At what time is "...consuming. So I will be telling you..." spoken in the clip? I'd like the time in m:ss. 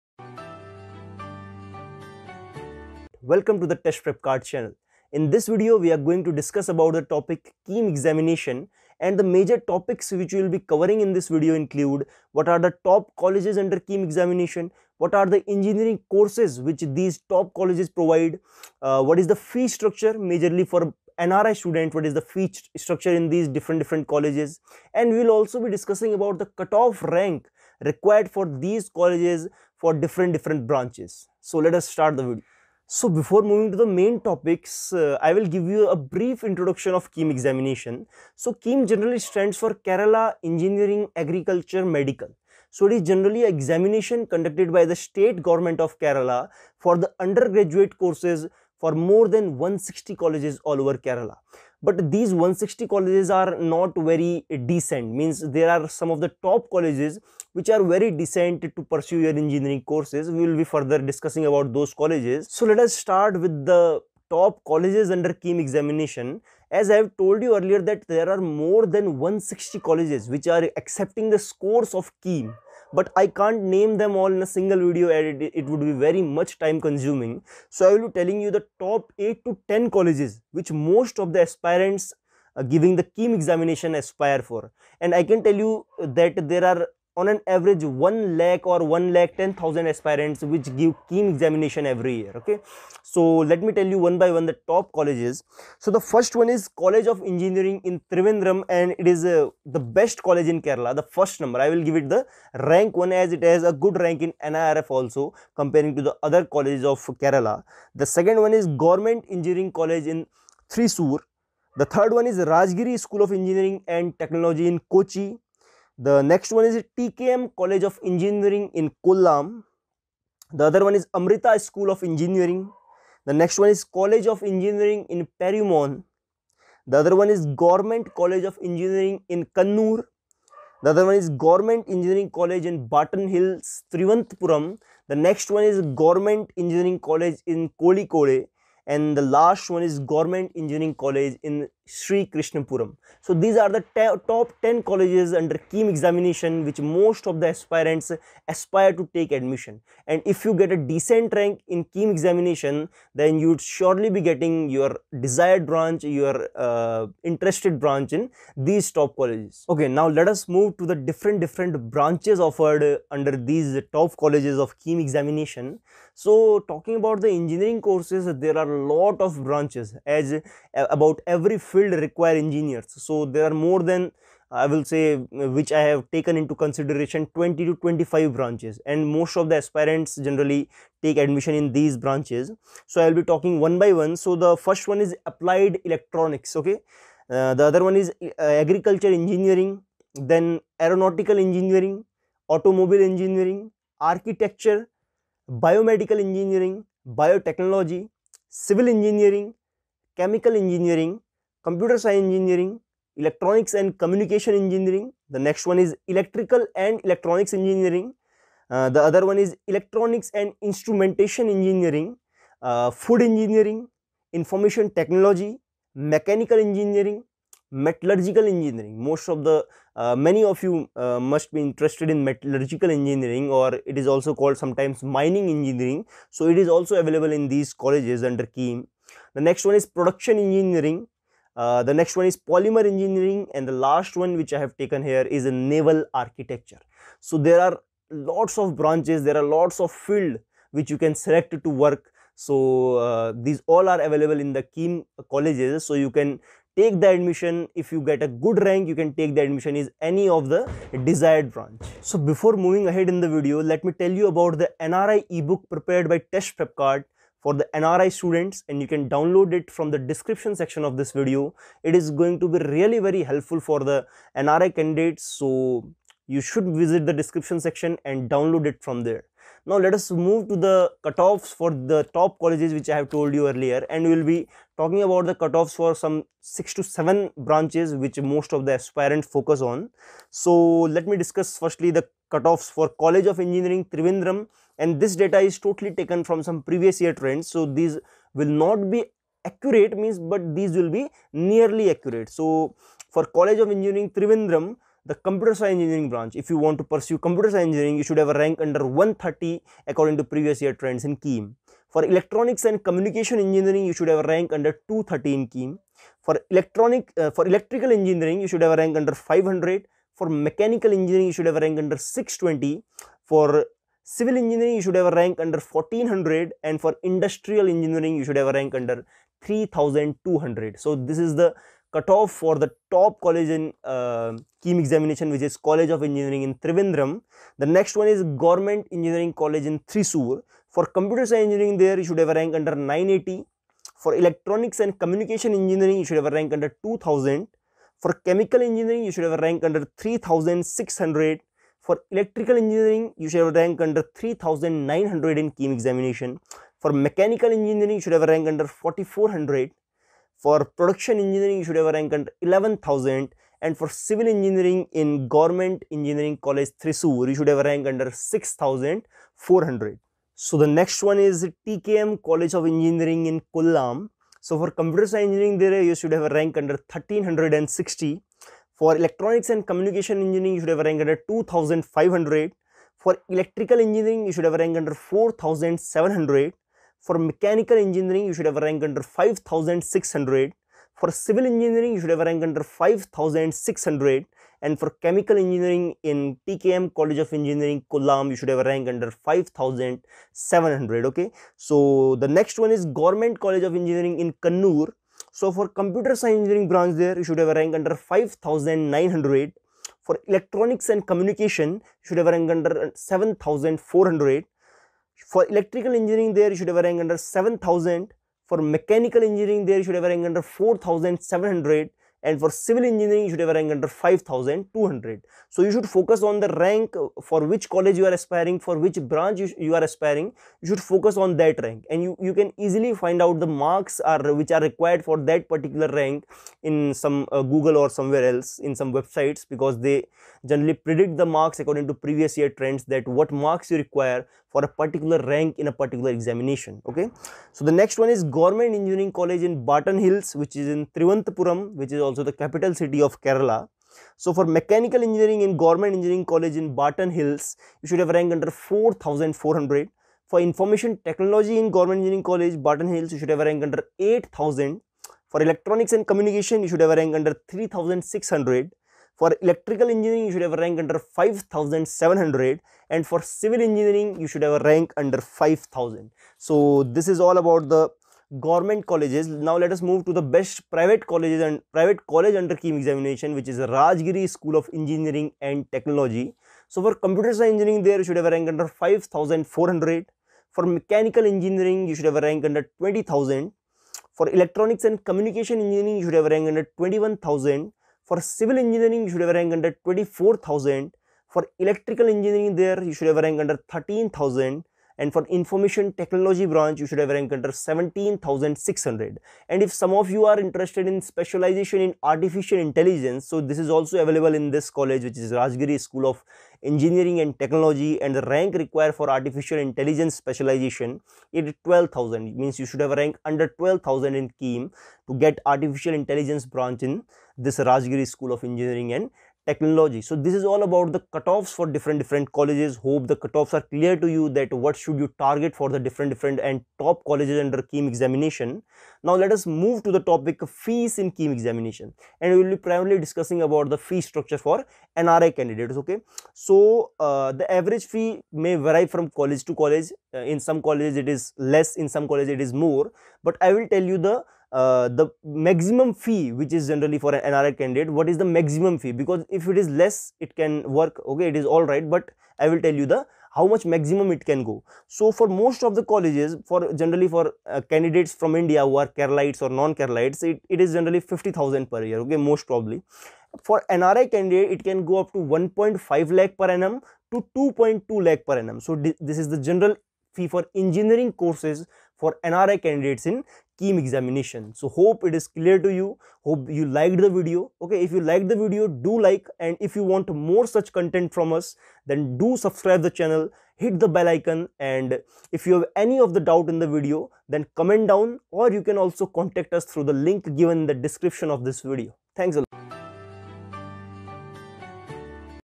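1:16.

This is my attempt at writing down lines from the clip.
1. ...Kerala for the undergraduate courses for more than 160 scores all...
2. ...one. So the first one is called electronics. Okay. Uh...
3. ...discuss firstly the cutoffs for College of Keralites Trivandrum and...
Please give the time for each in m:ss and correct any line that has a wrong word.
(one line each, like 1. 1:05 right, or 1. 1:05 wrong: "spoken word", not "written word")
1. 0:45 wrong: "colleges", not "scores"
2. 3:03 wrong: "applied", not "called"
3. 4:41 wrong: "Engineering", not "Keralites".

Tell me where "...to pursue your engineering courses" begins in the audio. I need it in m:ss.
0:58.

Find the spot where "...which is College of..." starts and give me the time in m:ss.
5:25.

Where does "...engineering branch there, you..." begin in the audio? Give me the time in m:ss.
6:36.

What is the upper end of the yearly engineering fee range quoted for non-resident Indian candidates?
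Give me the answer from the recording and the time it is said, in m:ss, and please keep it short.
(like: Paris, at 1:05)
2.2 lakh, at 9:27.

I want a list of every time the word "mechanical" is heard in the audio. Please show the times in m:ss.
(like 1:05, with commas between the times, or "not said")
3:35, 5:10, 5:46, 6:17, 6:48, 7:24, 8:00.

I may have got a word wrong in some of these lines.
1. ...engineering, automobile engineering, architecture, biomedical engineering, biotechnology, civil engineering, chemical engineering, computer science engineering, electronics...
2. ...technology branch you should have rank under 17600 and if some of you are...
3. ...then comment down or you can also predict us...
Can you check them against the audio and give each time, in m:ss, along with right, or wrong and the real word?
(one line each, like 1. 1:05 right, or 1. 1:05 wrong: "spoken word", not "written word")
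1. 3:11 right
2. 8:15 right
3. 9:47 wrong: "contact", not "predict".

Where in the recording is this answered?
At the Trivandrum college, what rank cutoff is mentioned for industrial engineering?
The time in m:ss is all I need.
5:18.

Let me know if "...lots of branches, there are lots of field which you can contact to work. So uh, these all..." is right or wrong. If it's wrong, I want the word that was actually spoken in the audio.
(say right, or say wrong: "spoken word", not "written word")
wrong: "select", not "contact".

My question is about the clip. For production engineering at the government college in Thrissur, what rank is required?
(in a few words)
11,000.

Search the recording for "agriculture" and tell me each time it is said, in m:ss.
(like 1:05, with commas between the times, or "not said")
0:41, 3:08.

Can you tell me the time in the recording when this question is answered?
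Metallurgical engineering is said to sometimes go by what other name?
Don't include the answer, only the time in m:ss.
3:45.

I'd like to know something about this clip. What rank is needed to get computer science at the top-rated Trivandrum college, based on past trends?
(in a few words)
under 130.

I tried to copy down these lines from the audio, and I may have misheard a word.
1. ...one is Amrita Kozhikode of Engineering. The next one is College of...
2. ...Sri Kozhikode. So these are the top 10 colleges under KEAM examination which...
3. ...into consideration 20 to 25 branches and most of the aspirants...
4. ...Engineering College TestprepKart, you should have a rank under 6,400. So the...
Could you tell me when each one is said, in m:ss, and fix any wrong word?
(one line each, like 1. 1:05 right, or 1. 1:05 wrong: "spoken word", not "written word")
1. 2:00 wrong: "School", not "Kozhikode"
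2. 2:21 wrong: "Krishnapuram", not "Kozhikode"
3. 2:56 right
4. 5:55 wrong: "Thrissur", not "TestprepKart".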